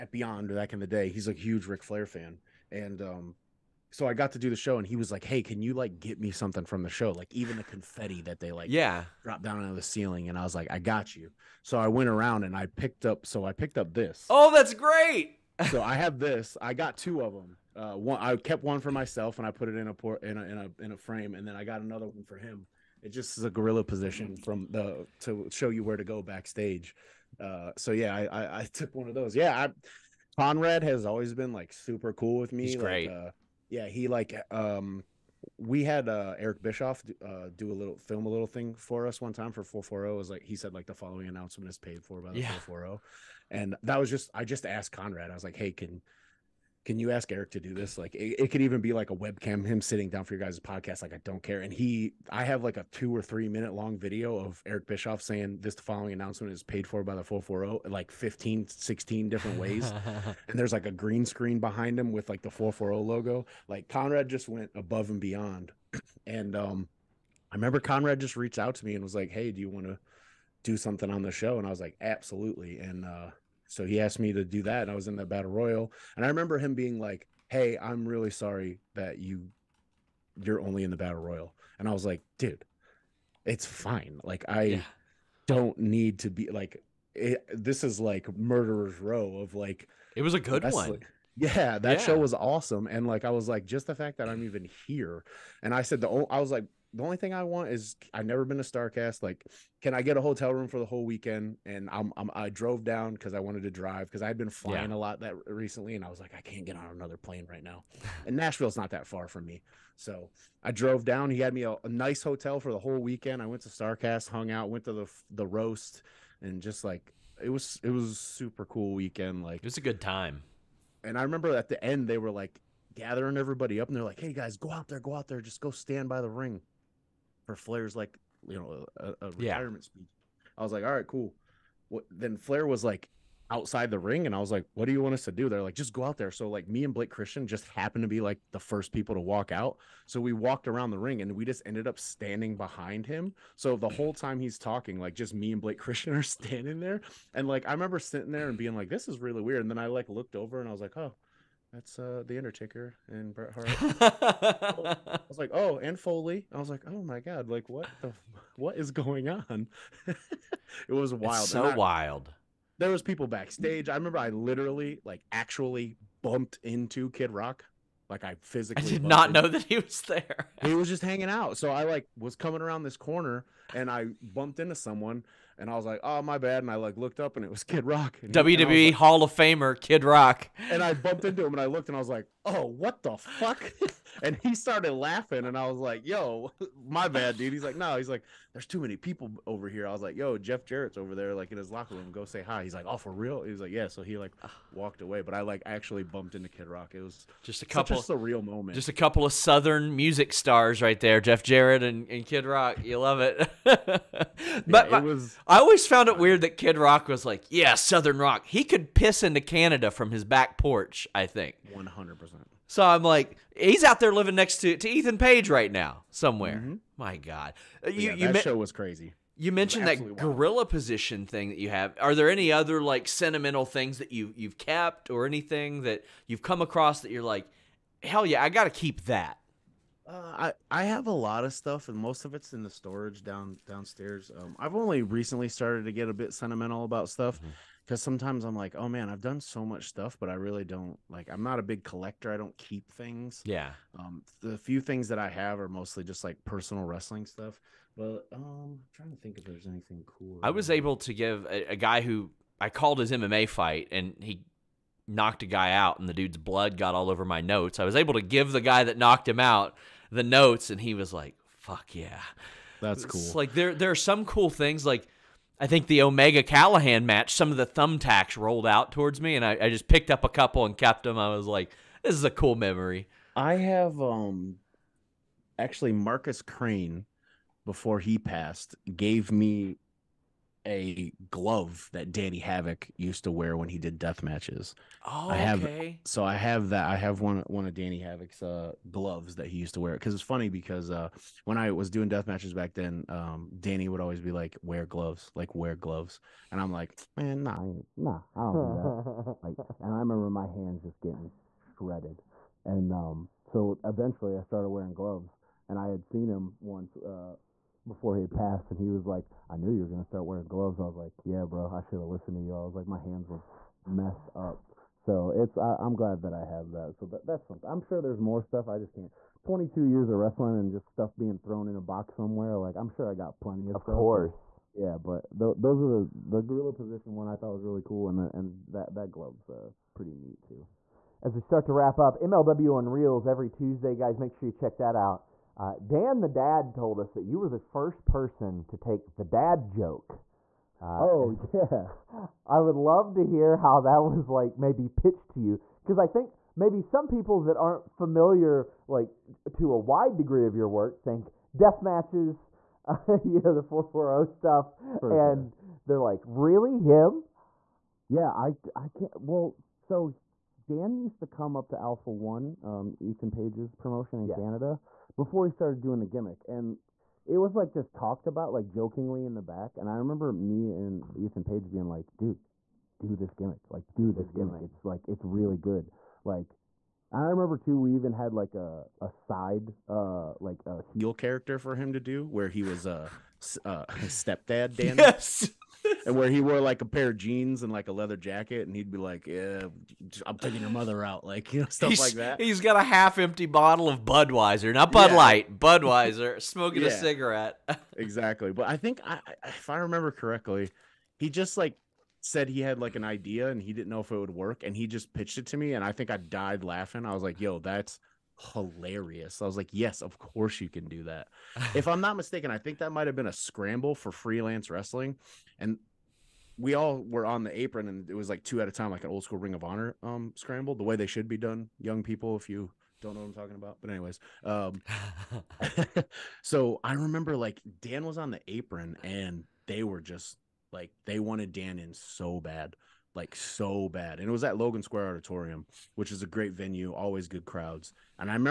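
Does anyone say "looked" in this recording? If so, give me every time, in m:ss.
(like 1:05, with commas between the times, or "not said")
2:30, 2:56, 3:01.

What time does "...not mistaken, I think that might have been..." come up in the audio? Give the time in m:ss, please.
6:51.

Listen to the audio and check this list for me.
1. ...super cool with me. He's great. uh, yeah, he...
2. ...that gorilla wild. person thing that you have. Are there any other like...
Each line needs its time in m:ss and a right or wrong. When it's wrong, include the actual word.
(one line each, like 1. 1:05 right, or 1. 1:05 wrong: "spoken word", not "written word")
1. 0:31 right
2. 3:39 wrong: "position", not "person".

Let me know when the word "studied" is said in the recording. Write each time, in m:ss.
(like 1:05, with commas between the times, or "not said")
not said.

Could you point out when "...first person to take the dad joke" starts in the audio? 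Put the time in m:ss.
5:37.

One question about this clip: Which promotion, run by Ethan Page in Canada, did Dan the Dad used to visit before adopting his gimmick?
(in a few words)
Alpha One.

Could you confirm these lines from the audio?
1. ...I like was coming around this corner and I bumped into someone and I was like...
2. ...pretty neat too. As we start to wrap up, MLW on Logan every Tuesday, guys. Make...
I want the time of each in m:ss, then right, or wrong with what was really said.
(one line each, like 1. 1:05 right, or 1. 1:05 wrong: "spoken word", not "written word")
1. 2:51 right
2. 5:29 wrong: "Reelz", not "Logan".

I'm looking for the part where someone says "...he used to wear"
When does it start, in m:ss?
4:49.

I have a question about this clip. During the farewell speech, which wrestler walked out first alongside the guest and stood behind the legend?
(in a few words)
Blake Christian.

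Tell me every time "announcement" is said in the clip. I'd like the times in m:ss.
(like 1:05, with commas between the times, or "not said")
0:41, 0:56.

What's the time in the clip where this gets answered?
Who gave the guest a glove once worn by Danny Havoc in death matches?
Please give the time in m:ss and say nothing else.
4:35.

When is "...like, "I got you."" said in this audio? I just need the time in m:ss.
0:10.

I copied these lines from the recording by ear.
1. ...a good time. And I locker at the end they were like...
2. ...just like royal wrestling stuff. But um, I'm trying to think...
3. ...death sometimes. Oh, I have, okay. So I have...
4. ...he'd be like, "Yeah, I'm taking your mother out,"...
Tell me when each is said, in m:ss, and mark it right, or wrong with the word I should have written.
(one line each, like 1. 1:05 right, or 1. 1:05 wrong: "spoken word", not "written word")
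1. 1:59 wrong: "remember", not "locker"
2. 4:06 wrong: "personal", not "royal"
3. 4:43 wrong: "matches", not "sometimes"
4. 6:28 right.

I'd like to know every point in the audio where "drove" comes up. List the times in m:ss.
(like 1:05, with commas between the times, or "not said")
1:42, 1:50.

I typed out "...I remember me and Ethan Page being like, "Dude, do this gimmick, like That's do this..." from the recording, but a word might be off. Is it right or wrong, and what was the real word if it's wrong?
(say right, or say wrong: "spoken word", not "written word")
right.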